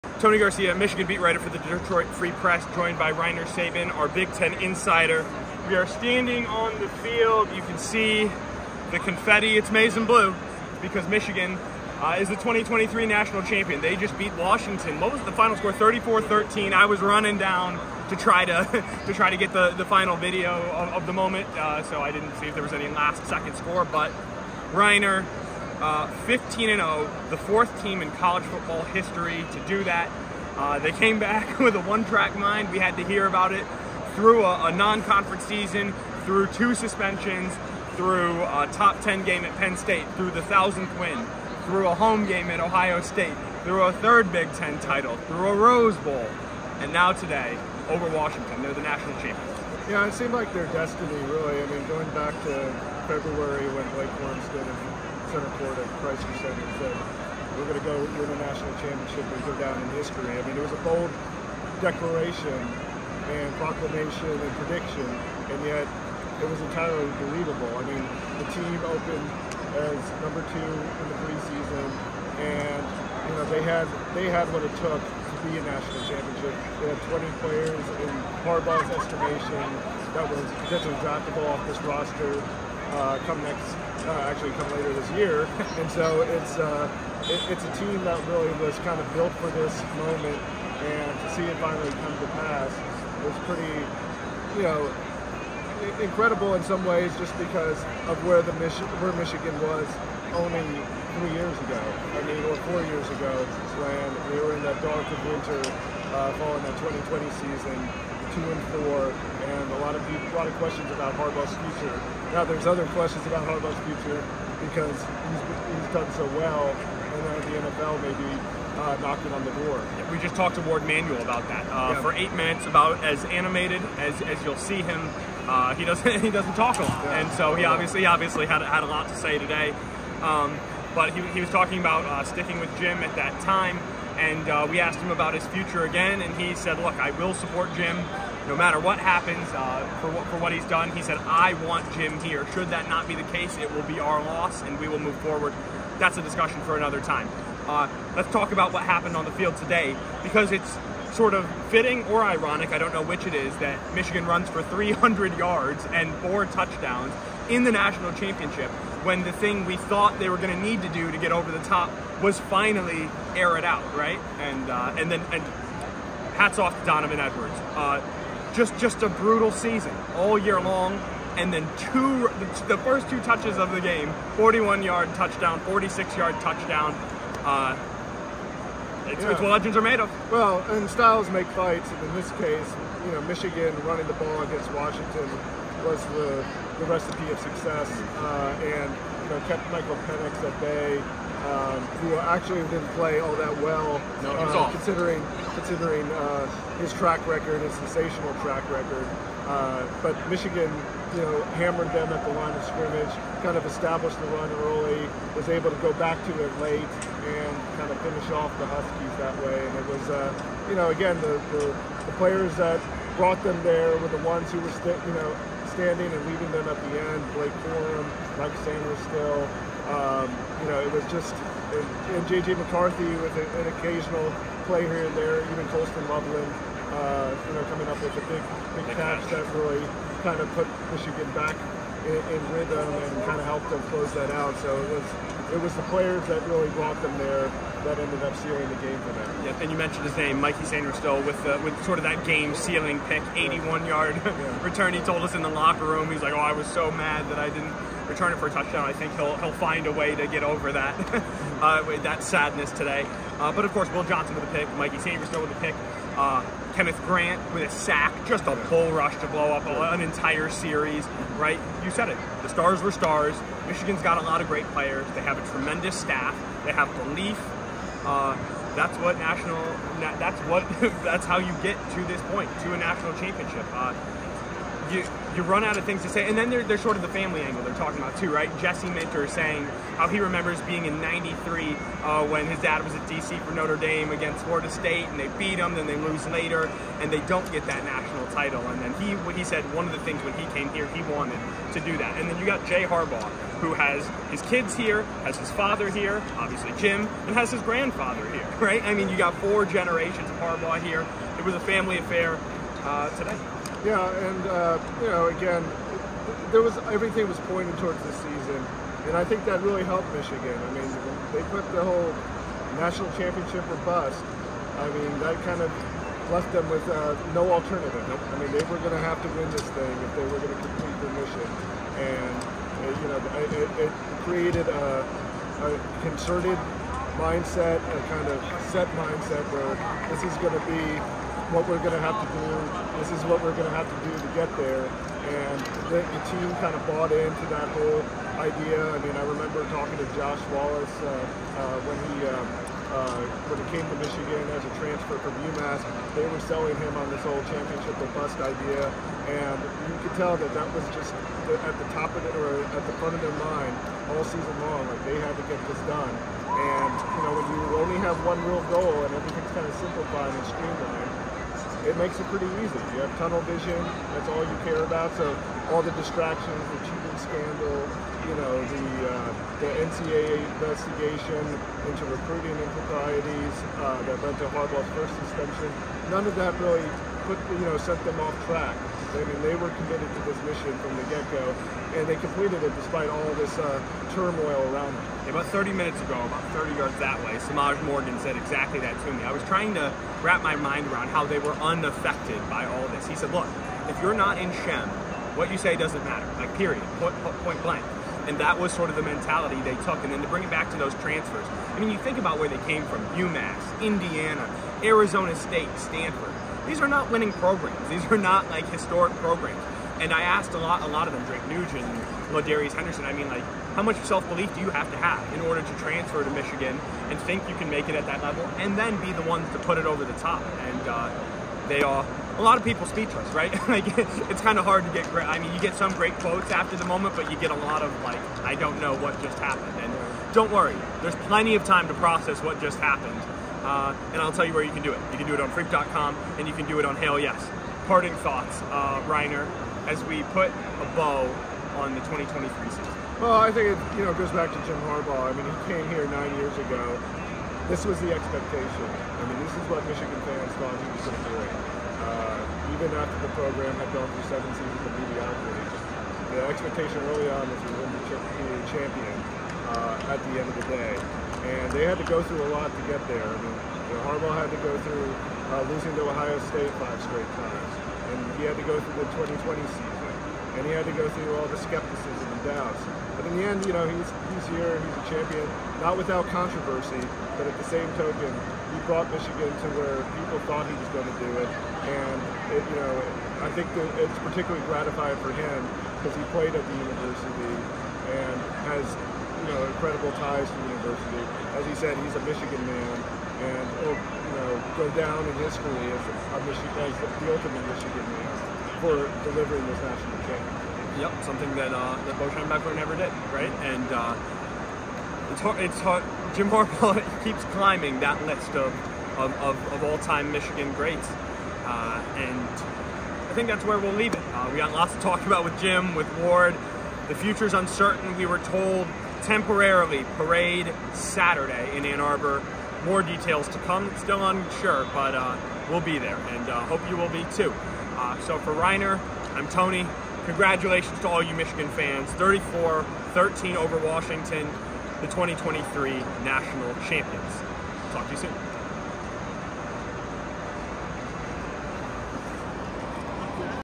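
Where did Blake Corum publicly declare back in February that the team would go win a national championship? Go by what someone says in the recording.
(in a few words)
Crisler Center.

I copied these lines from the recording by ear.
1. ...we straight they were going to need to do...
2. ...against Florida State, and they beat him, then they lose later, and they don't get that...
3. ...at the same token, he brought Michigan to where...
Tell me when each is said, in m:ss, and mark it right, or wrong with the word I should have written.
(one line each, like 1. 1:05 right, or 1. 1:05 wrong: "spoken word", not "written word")
1. 2:39 wrong: "thought", not "straight"
2. 4:44 right
3. 7:57 right.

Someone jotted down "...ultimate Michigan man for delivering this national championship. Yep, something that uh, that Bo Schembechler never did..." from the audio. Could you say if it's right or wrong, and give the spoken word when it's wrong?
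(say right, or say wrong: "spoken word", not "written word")
right.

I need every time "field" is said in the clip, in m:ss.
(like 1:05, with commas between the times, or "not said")
0:06, 2:29.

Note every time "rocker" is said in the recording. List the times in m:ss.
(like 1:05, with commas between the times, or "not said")
not said.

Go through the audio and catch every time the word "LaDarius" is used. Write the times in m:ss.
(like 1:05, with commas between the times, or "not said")
6:52.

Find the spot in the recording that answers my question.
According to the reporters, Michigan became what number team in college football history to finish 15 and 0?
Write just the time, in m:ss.
0:27.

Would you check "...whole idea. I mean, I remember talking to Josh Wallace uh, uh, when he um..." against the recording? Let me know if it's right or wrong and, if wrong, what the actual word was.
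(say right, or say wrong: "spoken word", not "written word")
right.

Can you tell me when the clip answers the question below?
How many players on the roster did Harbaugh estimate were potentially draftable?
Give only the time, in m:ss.
1:17.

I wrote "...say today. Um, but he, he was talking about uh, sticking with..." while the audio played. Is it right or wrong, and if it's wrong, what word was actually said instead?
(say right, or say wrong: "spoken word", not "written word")
right.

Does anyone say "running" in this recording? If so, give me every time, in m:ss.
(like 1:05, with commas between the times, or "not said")
0:17, 3:03.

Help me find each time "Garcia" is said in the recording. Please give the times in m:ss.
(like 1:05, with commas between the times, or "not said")
0:00.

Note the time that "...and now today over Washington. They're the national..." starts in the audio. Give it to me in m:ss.
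0:46.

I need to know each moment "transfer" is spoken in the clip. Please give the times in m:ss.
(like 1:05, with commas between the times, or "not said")
5:44, 6:40, 6:55.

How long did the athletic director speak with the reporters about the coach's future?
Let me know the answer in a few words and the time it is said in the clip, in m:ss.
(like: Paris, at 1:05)
8 minutes, at 2:02.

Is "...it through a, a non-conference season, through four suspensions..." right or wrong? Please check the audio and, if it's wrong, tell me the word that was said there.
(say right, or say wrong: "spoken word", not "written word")
wrong: "two", not "four".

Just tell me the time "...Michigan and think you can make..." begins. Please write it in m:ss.
6:56.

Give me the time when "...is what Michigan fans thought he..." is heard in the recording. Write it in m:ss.
7:29.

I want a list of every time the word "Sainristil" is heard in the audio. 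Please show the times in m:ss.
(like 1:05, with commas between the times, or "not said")
3:38, 4:00, 4:14.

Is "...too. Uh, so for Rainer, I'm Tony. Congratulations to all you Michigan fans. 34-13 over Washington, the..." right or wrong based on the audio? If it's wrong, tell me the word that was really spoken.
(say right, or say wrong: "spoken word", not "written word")
right.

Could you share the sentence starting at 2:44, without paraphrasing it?
And uh, and then and hats off to Donovan Edwards.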